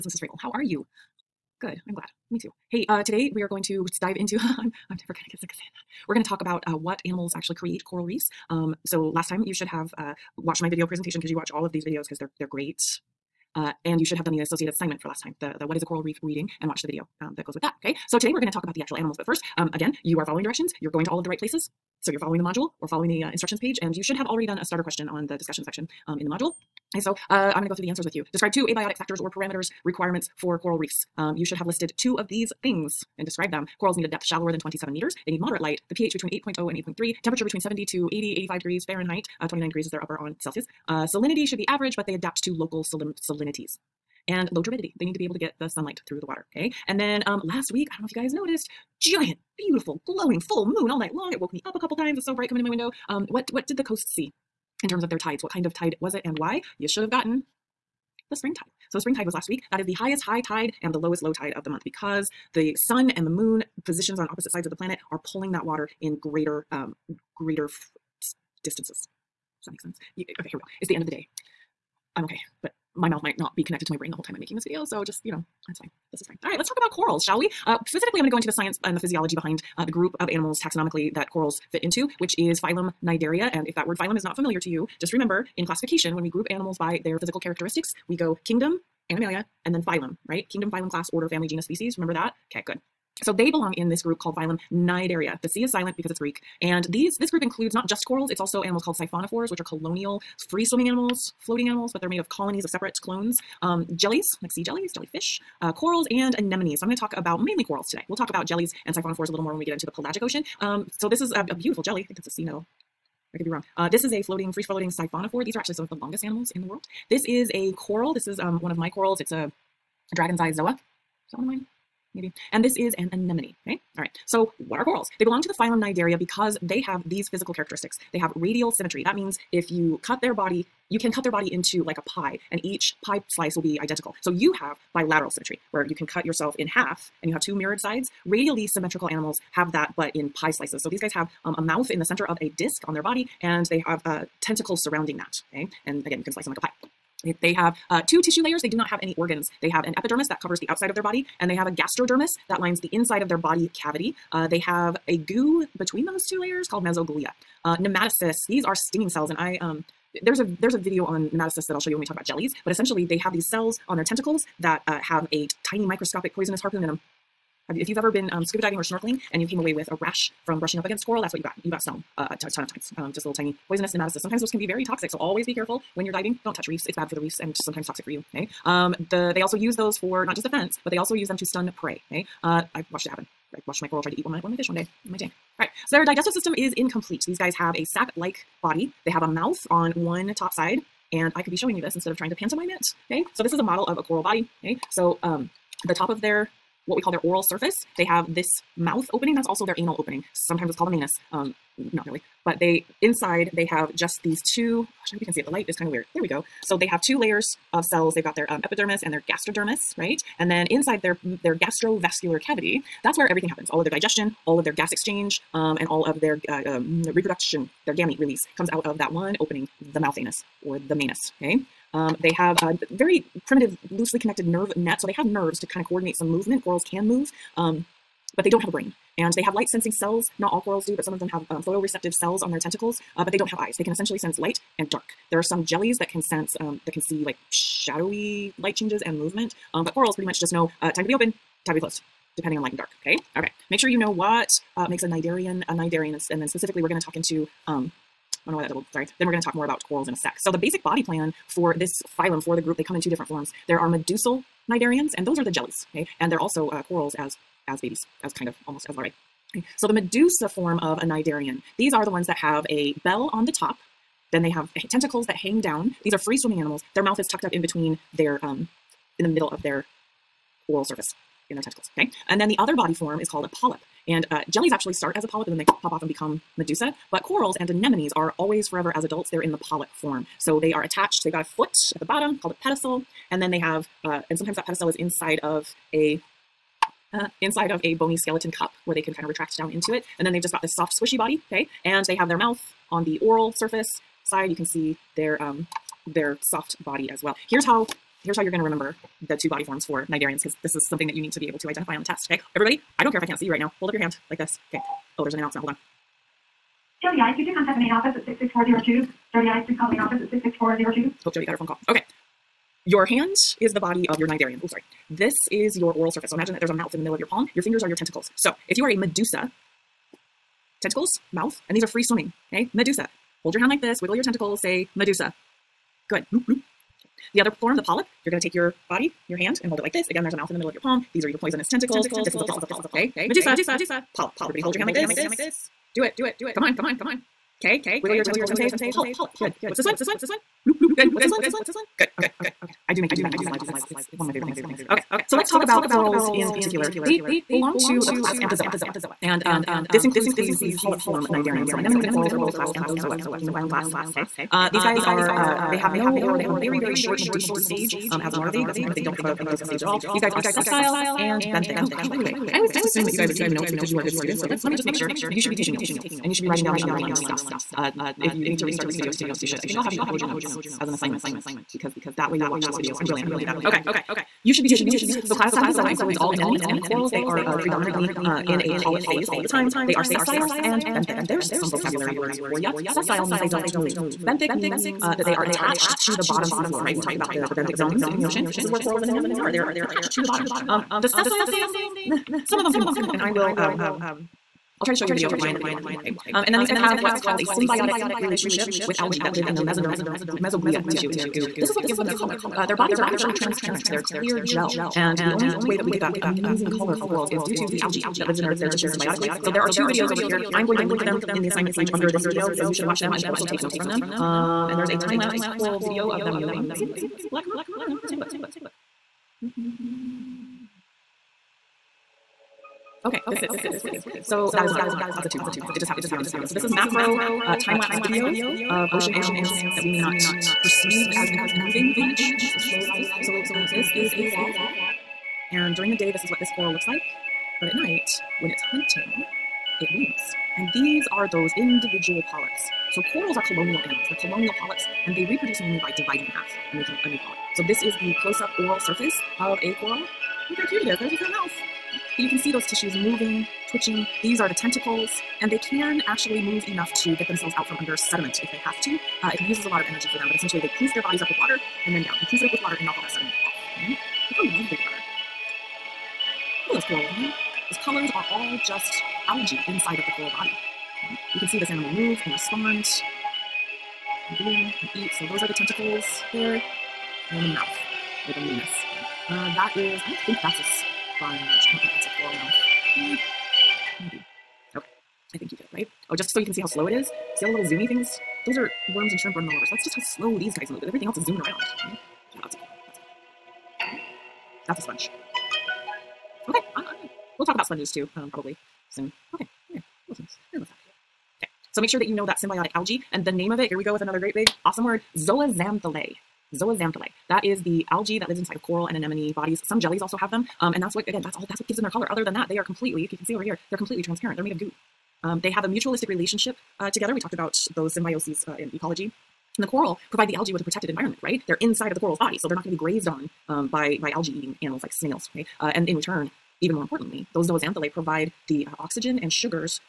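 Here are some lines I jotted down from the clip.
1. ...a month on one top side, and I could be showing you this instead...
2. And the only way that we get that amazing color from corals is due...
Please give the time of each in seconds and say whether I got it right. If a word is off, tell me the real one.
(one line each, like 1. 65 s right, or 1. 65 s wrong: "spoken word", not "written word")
1. 189 s wrong: "mouth", not "month"
2. 404 s right.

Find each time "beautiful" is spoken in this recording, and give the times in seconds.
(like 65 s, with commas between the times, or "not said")
49 s, 111 s.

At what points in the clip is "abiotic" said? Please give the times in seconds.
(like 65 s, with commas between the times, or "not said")
28 s.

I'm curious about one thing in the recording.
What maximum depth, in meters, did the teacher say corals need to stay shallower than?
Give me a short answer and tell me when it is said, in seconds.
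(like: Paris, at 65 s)
27 meters, at 34 s.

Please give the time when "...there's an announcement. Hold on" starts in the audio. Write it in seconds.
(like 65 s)
305 s.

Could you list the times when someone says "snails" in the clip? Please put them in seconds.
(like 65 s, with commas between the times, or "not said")
524 s.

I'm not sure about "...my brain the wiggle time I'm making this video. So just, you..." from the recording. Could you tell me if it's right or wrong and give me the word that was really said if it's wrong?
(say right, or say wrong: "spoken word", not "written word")
wrong: "whole", not "wiggle".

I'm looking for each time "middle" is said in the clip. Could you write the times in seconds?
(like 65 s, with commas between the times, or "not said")
269 s, 317 s, 330 s.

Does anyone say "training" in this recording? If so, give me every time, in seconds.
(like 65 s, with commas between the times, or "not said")
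not said.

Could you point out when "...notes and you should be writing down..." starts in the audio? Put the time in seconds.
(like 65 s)
365 s.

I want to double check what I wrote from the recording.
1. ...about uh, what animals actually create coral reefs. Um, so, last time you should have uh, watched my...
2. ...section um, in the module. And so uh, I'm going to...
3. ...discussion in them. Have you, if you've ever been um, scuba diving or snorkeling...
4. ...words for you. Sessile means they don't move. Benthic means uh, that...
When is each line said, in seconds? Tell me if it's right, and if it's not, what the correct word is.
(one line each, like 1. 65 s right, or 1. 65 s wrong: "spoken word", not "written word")
1. 6 s right
2. 25 s right
3. 166 s wrong: "harpoon", not "discussion"
4. 382 s right.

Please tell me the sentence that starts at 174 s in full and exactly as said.
Sometimes those can be very toxic, so always be careful when you're diving.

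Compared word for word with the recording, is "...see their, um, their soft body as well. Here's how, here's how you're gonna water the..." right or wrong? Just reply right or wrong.
wrong.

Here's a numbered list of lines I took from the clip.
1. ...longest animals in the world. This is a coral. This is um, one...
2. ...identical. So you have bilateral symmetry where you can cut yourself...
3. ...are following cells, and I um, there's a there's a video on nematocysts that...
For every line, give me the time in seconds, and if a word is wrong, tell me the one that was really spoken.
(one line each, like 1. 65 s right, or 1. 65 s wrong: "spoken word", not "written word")
1. 115 s right
2. 133 s right
3. 158 s wrong: "stinging", not "following".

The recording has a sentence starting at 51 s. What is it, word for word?
It woke me up a couple times.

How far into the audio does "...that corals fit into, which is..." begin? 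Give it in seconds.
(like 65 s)
81 s.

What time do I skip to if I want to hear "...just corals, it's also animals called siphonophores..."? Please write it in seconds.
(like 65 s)
97 s.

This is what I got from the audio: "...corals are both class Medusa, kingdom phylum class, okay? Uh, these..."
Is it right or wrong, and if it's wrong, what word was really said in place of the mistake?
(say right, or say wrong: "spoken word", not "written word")
wrong: "Anthozoa", not "Medusa".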